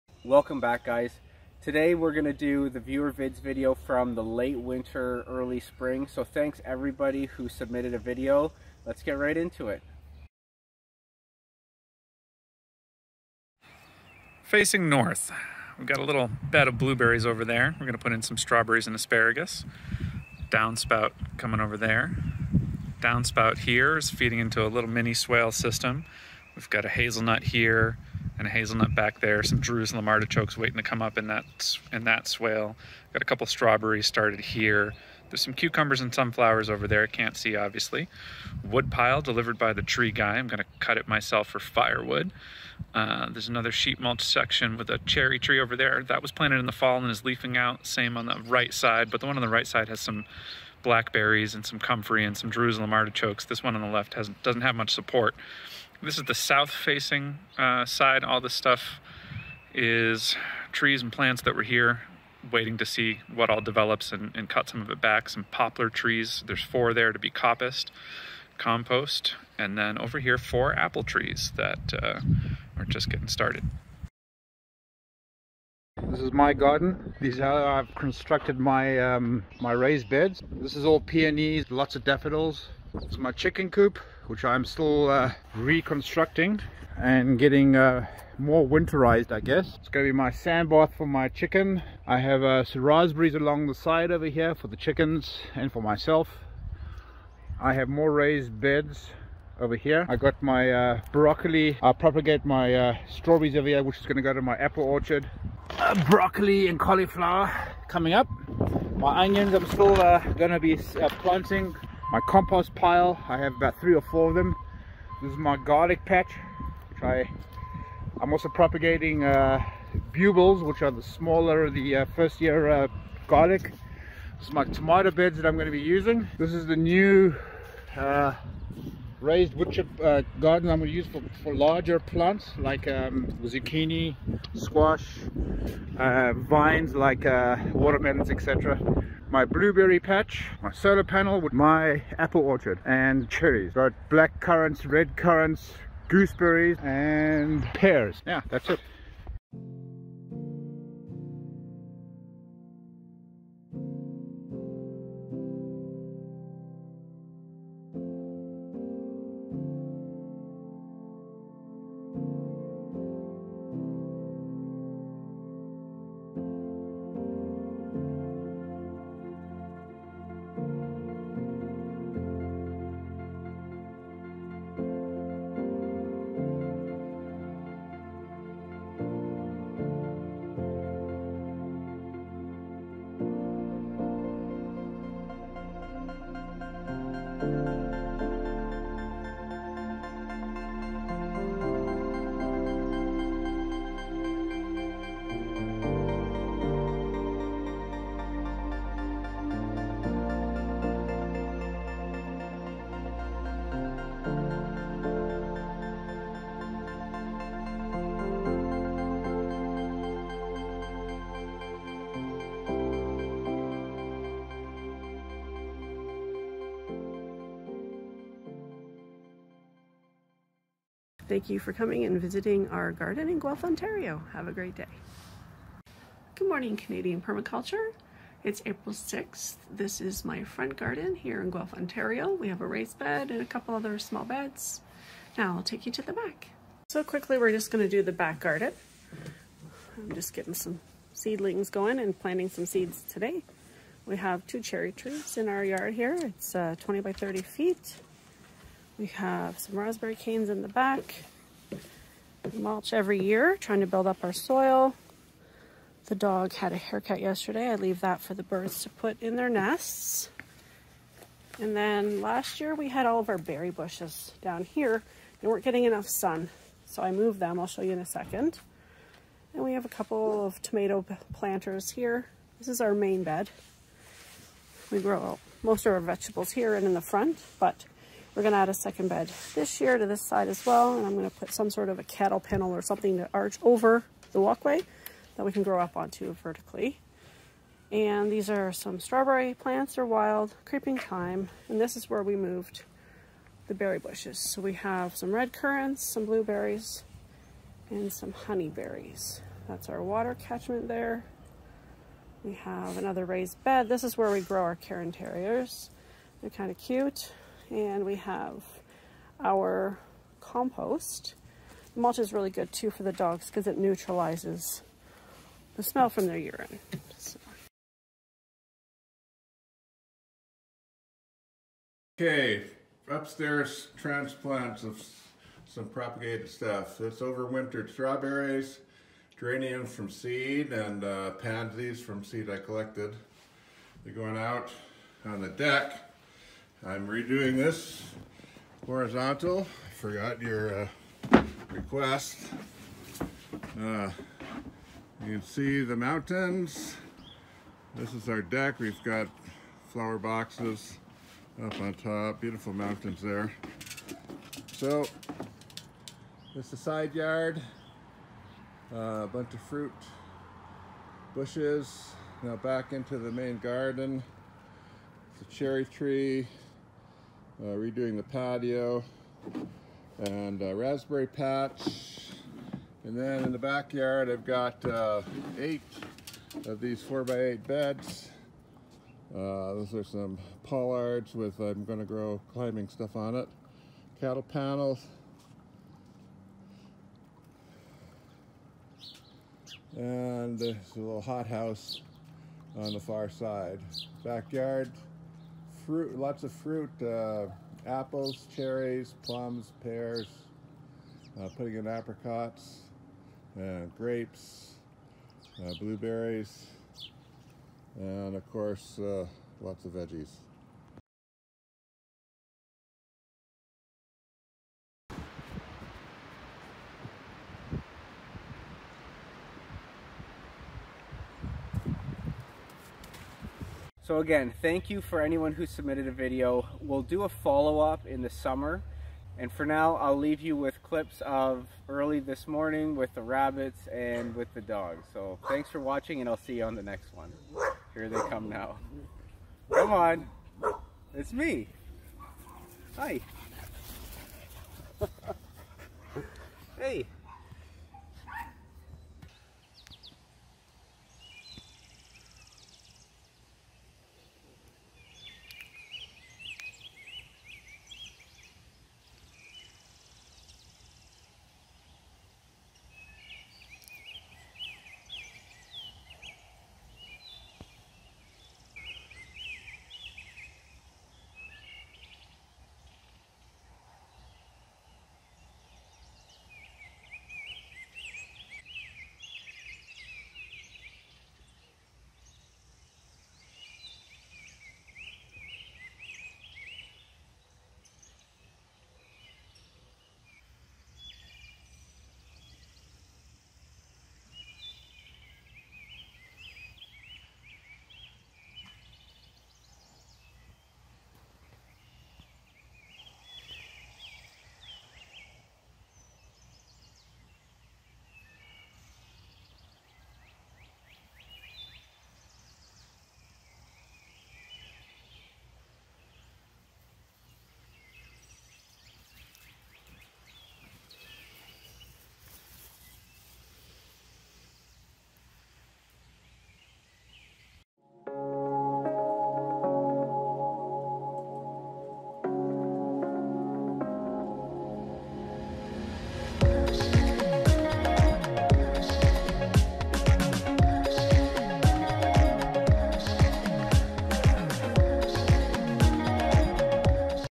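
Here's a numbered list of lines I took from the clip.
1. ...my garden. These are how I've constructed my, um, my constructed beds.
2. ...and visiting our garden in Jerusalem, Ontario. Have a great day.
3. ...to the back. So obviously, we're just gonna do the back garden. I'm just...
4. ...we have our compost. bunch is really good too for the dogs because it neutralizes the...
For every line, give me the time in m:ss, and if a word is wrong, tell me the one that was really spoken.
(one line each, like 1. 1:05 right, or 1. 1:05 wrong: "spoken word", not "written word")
1. 1:16 wrong: "raised", not "constructed"
2. 3:42 wrong: "Guelph", not "Jerusalem"
3. 3:55 wrong: "quickly", not "obviously"
4. 5:08 wrong: "mulch", not "bunch".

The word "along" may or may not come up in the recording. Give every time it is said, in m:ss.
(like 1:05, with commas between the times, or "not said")
1:33.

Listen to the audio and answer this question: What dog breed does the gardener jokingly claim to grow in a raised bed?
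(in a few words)
Cairn Terriers.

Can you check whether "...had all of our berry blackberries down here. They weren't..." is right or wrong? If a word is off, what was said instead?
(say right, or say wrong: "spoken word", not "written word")
wrong: "bushes", not "blackberries".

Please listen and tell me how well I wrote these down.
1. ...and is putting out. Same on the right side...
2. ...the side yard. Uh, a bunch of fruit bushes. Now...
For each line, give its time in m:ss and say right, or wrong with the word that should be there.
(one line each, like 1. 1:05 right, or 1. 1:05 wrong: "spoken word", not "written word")
1. 0:46 wrong: "leafing", not "putting"
2. 5:56 right.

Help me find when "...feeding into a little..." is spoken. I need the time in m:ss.
0:24.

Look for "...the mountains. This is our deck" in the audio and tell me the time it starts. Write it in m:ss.
5:45.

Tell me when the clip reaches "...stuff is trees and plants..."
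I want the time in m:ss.
0:58.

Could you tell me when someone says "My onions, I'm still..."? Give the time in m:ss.
1:48.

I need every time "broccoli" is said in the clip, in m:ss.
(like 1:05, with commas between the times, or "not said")
1:41, 1:46.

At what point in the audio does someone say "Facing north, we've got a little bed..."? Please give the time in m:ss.
0:14.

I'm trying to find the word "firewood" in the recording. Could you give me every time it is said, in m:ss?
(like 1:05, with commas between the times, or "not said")
0:41.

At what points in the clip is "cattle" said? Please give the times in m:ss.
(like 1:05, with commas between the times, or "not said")
4:42, 6:24.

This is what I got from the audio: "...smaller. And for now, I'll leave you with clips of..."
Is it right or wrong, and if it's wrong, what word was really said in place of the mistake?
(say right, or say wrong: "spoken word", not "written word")
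wrong: "summer", not "smaller".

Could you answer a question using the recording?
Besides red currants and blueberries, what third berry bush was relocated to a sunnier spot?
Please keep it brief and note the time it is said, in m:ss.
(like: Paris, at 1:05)
Honeyberries, at 4:58.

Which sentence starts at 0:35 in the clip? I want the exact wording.
There's some cucumbers and sunflowers over there.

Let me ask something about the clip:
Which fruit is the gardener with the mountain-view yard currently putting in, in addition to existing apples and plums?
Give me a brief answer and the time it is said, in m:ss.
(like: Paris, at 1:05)
Apricots, at 6:41.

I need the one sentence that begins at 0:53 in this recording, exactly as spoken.
This one on the left has, doesn't have much support.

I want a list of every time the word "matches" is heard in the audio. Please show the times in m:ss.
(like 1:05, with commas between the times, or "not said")
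not said.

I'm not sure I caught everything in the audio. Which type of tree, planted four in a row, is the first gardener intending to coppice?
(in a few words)
Poplar.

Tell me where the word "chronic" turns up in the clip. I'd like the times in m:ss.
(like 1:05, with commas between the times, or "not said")
not said.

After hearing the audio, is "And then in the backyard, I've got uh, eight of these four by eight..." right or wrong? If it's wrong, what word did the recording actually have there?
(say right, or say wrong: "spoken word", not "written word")
right.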